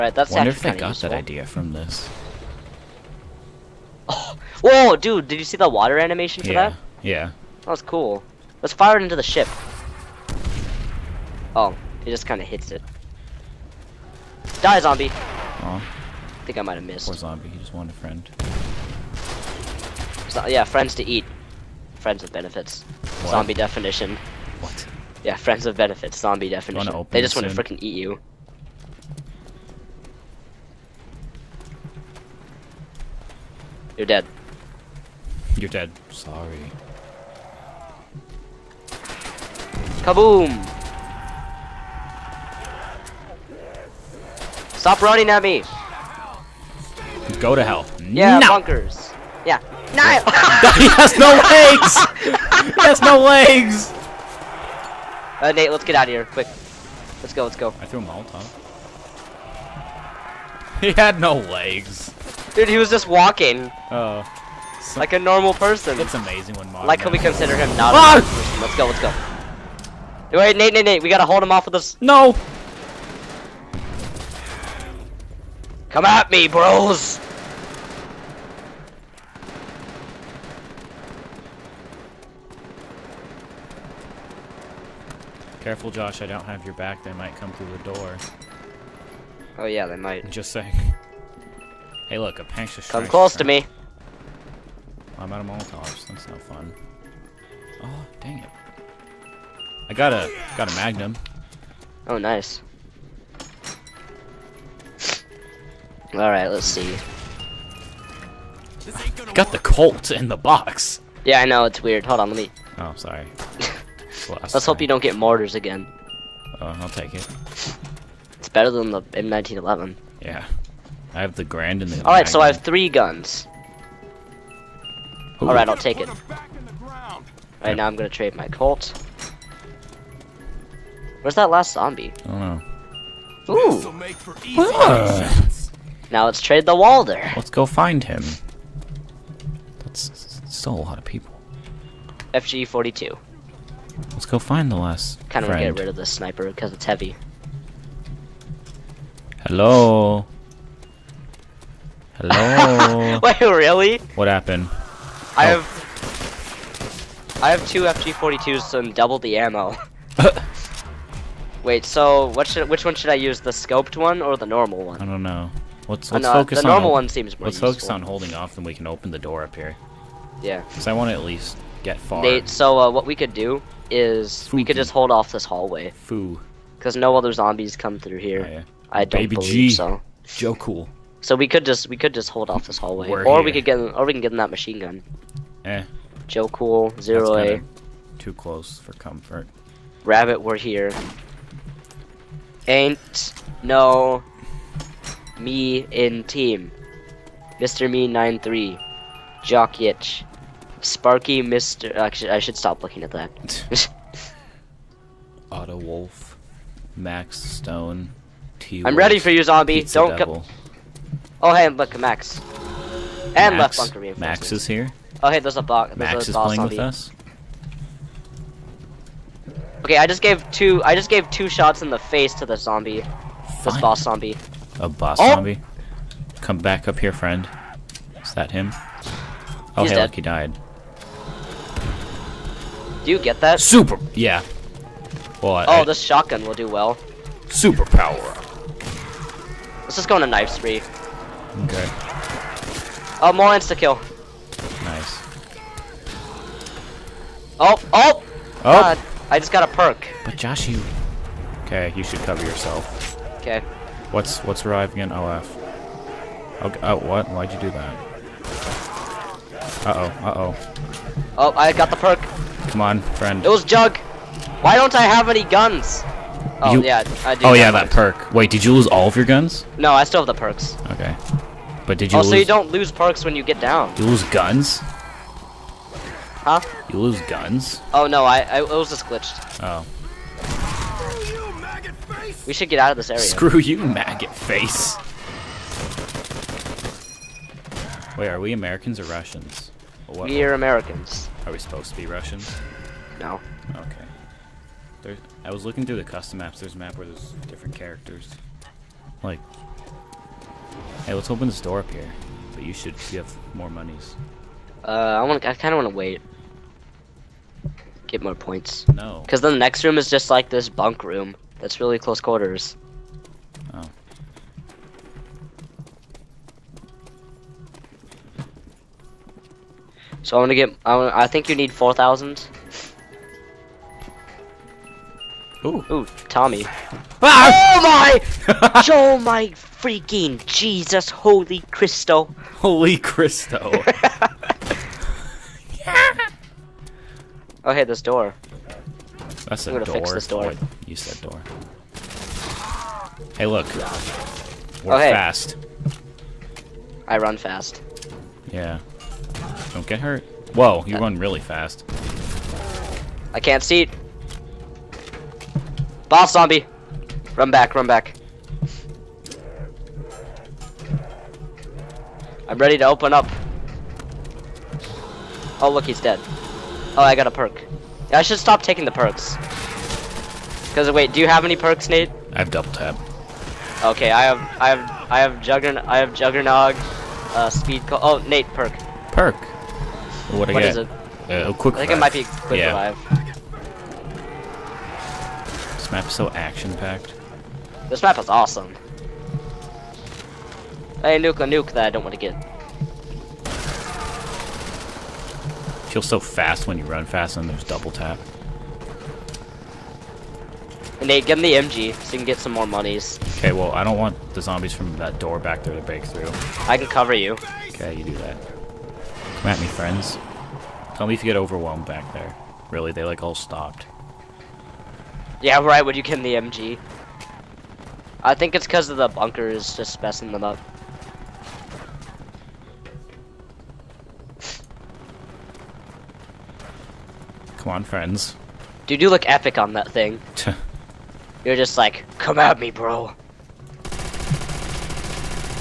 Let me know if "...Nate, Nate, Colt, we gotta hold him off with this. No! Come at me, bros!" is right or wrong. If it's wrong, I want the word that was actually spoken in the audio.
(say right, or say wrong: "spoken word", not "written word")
wrong: "Nate", not "Colt".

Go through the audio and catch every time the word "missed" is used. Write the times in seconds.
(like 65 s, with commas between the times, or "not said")
16 s.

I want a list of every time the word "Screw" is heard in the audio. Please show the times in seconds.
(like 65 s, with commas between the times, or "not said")
283 s.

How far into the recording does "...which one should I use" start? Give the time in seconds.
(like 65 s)
162 s.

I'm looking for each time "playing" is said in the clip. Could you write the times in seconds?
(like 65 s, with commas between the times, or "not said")
216 s.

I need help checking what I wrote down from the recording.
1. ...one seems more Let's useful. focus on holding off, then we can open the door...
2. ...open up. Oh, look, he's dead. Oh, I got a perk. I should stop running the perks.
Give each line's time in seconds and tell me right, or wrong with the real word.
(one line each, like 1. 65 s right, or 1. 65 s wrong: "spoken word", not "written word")
1. 166 s right
2. 362 s wrong: "taking", not "running".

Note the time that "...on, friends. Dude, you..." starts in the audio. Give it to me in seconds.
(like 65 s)
427 s.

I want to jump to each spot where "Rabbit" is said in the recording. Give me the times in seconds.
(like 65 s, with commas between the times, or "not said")
190 s.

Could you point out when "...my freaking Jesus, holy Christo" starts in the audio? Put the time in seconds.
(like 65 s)
329 s.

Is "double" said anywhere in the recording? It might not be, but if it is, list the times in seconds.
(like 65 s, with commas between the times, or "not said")
158 s, 372 s, 397 s.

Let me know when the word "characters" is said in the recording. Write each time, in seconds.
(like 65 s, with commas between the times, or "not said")
297 s.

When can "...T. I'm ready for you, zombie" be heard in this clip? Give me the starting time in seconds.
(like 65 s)
208 s.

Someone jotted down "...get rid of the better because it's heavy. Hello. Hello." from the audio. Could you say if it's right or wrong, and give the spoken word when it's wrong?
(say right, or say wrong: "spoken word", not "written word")
wrong: "sniper", not "better".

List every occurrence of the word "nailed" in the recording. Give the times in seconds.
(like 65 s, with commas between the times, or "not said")
not said.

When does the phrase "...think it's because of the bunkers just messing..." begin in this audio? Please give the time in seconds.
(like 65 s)
418 s.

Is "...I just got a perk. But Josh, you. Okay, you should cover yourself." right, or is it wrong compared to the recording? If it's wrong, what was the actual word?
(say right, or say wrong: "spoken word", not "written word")
right.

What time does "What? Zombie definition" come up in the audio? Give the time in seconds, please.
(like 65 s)
23 s.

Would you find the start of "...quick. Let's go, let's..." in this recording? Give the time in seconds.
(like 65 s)
56 s.